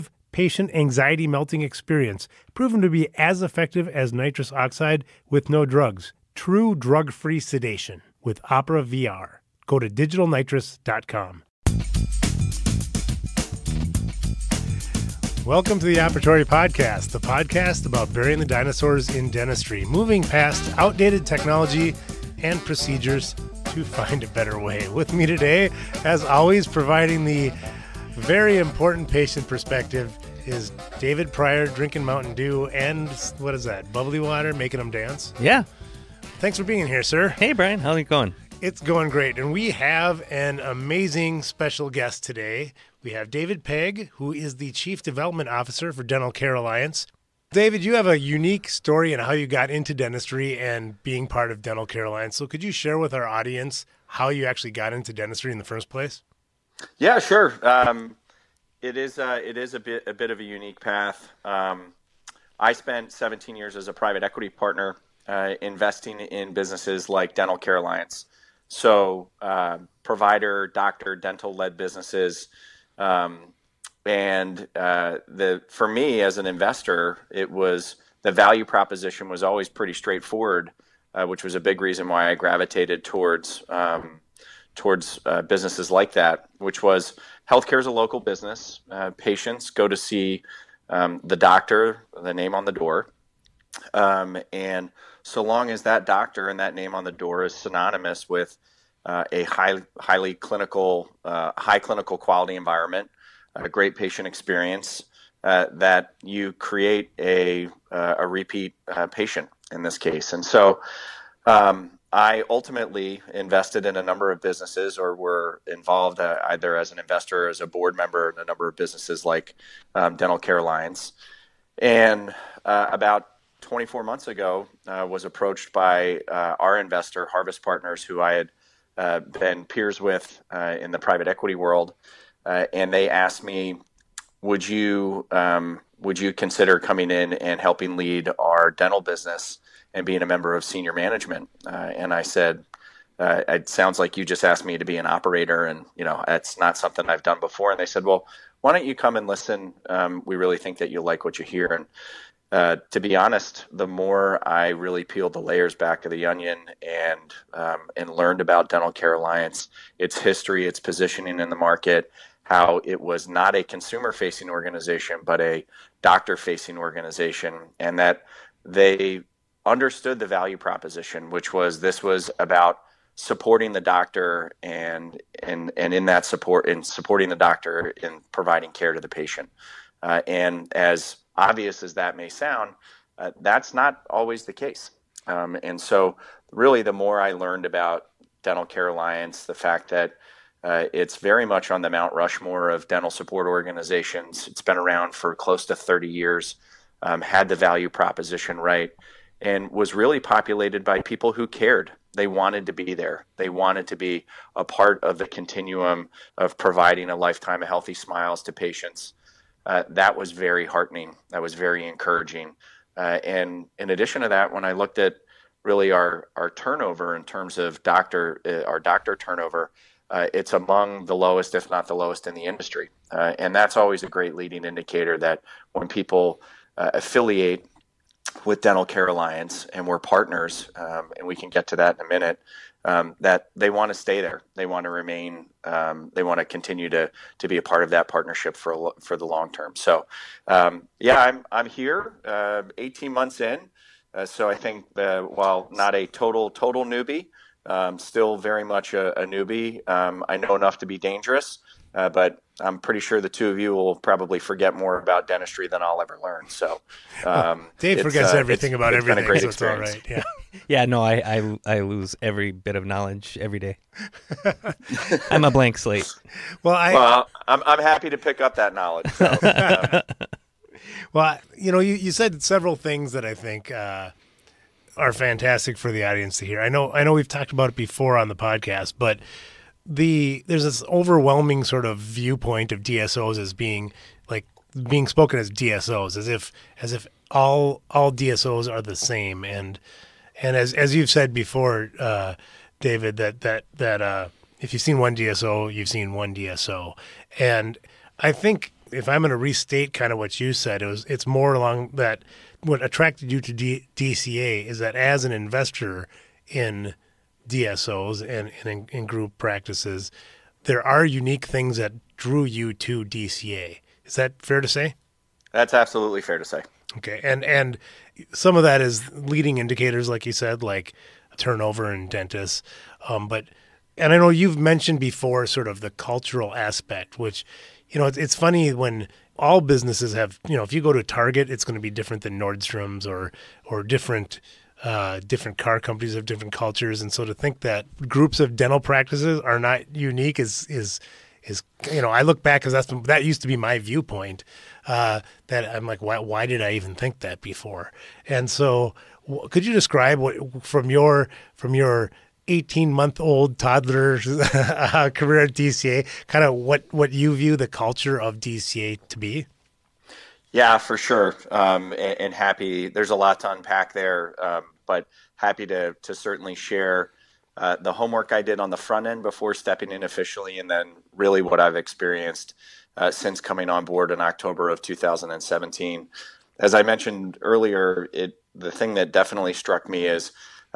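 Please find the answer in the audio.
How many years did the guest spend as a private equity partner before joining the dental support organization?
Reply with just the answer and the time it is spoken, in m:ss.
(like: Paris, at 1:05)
17, at 1:03.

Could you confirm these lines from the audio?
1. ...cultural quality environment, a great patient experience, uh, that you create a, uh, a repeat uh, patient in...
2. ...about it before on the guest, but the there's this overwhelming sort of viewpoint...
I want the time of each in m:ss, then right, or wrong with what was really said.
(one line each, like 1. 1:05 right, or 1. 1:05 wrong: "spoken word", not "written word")
1. 1:41 wrong: "clinical", not "cultural"
2. 4:37 wrong: "podcast", not "guest".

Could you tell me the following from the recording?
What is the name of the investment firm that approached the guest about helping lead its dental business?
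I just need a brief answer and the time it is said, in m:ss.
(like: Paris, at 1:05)
Harvest Partners, at 2:07.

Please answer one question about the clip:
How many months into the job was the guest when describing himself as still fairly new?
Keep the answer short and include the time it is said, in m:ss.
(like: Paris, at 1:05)
18, at 4:02.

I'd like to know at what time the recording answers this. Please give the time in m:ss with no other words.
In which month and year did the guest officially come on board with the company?
6:14.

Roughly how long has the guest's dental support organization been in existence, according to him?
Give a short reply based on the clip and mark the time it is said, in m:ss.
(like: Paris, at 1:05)
close to 30 years, at 3:15.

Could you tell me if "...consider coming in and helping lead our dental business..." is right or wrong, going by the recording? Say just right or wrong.
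right.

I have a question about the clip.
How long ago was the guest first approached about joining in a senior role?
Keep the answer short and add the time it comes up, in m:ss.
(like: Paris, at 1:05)
24 months, at 2:03.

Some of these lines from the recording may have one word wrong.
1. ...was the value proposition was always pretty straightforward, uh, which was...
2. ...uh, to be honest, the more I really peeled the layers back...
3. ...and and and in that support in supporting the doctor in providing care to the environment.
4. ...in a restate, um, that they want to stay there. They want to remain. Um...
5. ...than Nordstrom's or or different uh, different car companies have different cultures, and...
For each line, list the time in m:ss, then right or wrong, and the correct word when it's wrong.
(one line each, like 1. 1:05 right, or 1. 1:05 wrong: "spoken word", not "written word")
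1. 1:17 right
2. 2:32 right
3. 2:54 wrong: "patient", not "environment"
4. 3:51 wrong: "minute", not "restate"
5. 5:32 right.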